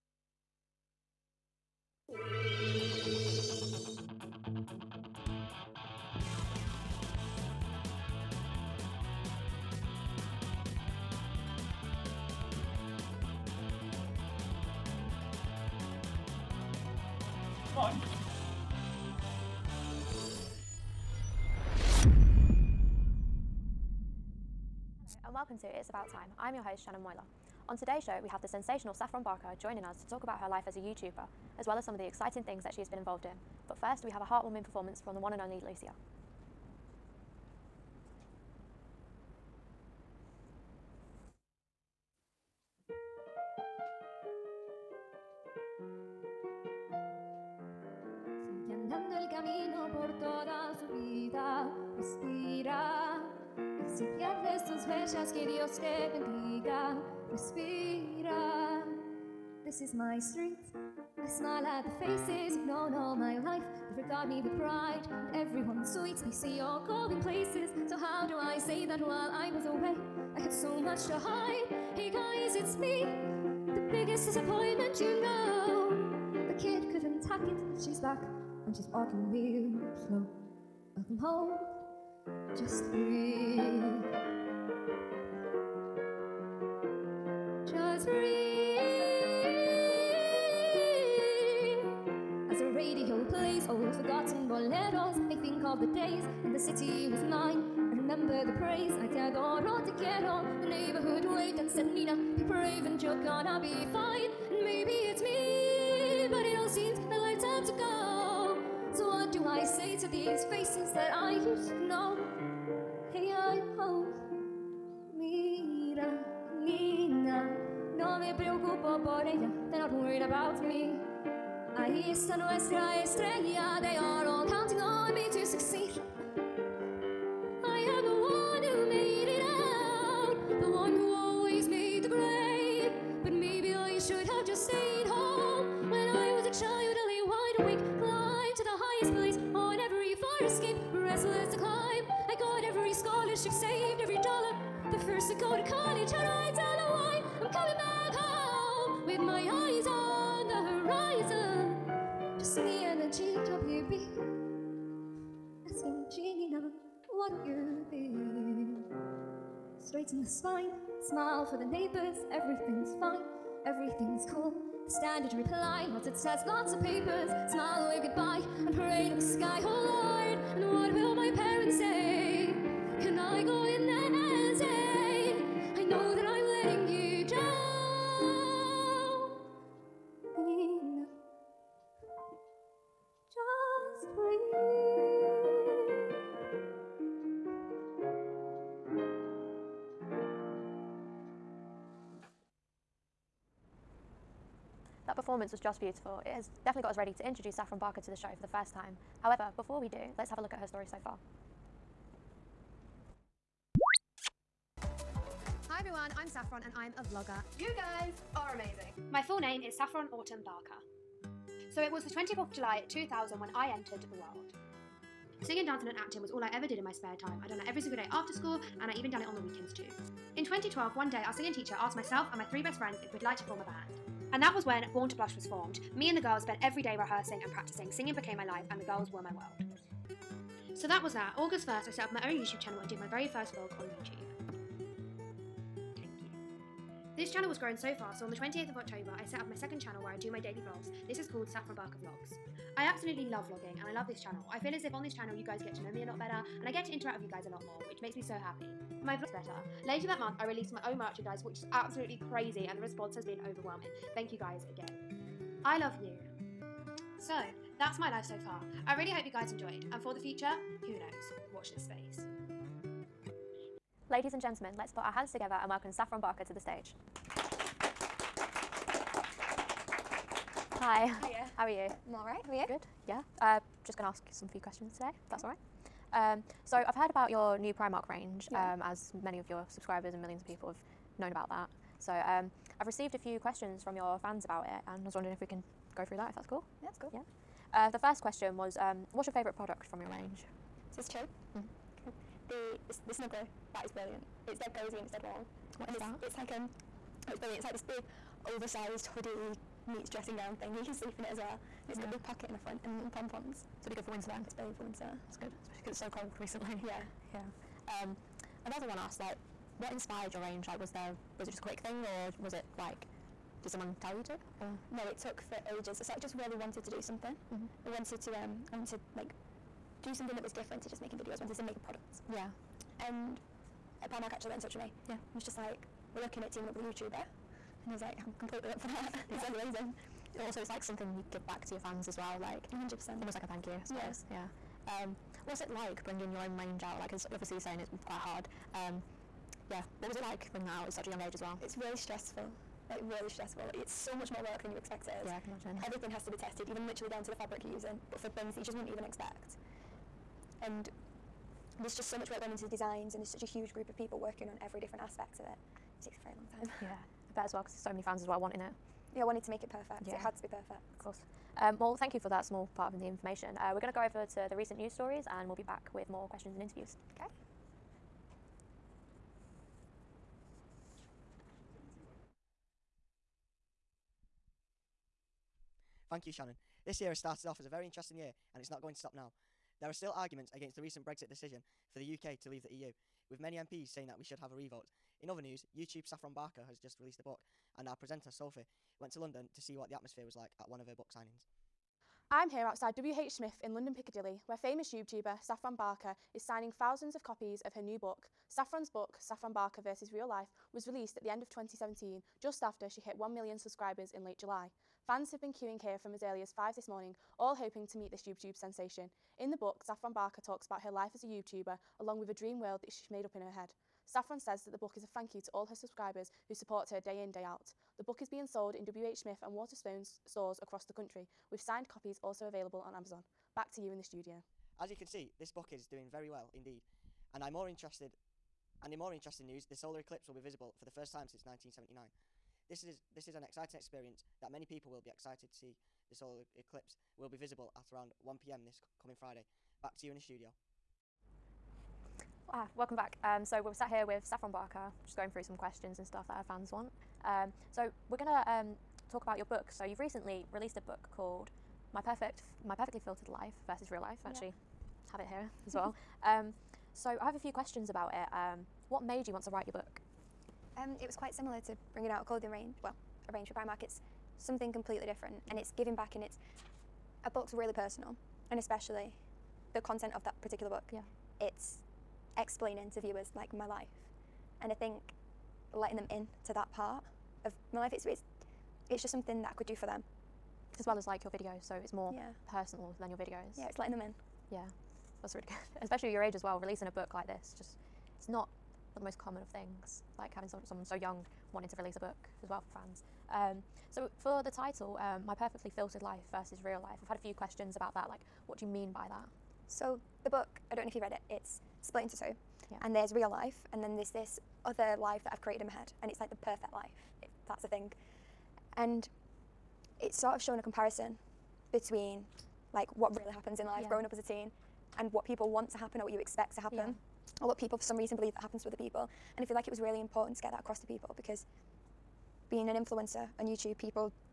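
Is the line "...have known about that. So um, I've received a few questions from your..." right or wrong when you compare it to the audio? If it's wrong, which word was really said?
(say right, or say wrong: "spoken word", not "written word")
right.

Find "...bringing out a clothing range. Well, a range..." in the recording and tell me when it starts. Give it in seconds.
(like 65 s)
461 s.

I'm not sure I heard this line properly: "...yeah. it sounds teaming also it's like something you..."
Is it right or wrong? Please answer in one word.
wrong.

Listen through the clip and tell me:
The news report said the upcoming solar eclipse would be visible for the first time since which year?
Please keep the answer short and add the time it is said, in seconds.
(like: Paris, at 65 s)
1979, at 431 s.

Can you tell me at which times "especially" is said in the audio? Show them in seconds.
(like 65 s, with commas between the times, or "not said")
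305 s, 468 s, 485 s.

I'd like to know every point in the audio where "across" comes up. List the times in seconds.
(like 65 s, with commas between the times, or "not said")
420 s, 520 s.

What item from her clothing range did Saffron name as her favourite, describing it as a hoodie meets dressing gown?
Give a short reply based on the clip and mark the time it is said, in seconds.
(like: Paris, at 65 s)
The snuggler, at 293 s.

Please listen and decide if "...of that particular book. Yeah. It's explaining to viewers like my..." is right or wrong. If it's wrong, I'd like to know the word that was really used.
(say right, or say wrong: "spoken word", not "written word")
right.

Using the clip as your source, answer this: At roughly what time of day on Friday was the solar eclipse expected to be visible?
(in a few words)
1 pm.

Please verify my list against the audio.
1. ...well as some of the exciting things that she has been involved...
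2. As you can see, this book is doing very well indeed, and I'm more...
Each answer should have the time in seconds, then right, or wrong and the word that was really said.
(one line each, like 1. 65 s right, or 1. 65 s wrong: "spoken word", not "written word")
1. 31 s right
2. 424 s right.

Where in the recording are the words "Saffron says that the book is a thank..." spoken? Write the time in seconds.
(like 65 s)
414 s.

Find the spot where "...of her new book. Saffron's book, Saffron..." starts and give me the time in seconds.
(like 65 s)
397 s.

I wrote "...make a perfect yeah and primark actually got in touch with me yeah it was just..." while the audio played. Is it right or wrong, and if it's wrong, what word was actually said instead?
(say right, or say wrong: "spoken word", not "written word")
wrong: "product", not "perfect".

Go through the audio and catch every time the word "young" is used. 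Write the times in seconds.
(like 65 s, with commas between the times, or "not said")
341 s, 490 s.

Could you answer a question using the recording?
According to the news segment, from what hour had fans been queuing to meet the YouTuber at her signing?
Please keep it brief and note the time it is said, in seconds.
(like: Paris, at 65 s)
5 in the morning, at 406 s.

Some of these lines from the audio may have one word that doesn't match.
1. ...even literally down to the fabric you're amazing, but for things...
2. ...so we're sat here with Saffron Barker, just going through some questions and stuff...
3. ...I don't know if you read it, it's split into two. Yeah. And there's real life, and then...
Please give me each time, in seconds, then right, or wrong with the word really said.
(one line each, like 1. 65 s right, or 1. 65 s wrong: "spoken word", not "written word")
1. 346 s wrong: "using", not "amazing"
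2. 443 s right
3. 500 s right.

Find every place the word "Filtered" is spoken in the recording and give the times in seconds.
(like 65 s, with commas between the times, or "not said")
453 s, 495 s.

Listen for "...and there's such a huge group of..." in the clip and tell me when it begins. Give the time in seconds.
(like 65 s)
353 s.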